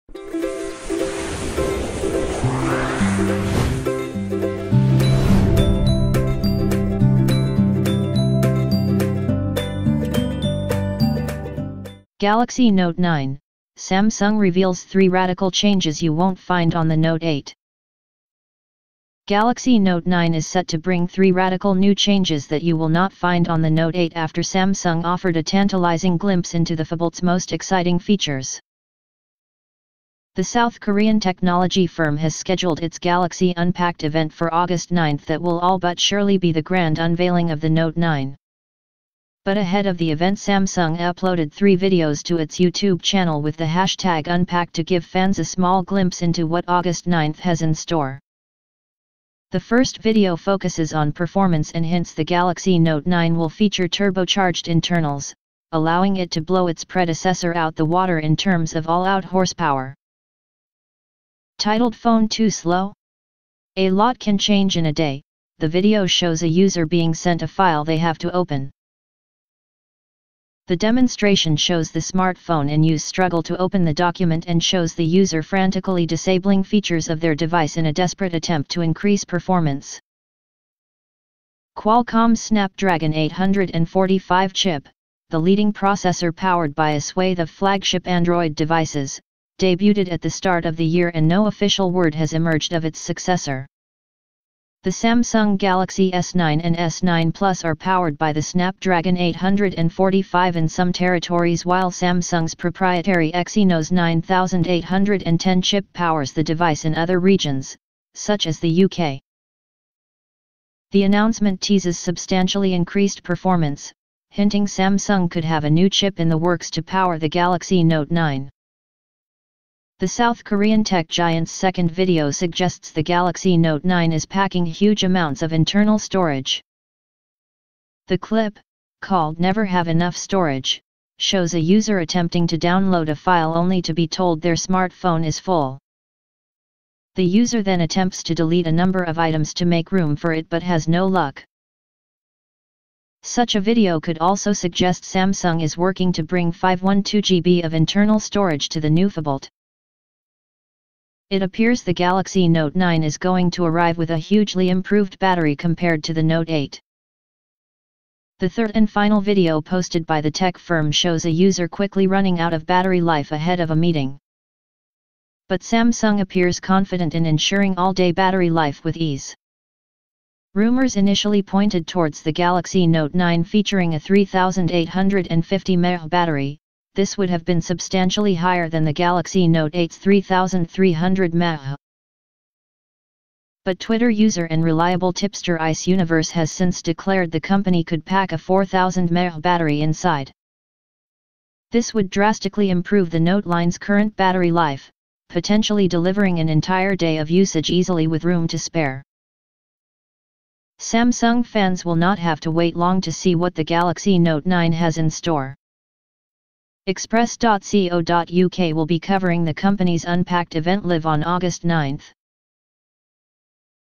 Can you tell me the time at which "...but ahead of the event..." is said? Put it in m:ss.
0:39.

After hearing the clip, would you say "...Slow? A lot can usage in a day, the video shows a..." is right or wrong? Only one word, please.
wrong.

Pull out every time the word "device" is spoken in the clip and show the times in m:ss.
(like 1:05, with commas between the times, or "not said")
1:17, 1:28, 1:46.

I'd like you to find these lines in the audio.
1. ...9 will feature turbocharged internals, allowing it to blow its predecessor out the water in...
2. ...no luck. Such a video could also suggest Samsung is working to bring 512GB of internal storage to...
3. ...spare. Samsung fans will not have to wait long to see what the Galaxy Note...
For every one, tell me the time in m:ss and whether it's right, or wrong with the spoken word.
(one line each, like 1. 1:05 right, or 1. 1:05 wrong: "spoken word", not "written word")
1. 0:53 right
2. 2:20 right
3. 3:18 right.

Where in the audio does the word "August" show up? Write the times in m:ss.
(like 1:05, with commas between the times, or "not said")
0:34, 0:46, 3:31.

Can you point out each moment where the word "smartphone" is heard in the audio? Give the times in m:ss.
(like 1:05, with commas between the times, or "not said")
1:11, 2:14.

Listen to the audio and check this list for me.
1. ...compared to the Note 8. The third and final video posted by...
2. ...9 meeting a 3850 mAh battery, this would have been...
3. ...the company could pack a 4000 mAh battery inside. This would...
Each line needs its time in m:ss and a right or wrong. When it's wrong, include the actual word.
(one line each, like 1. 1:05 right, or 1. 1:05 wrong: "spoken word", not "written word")
1. 2:35 right
2. 2:53 wrong: "featuring", not "meeting"
3. 3:07 right.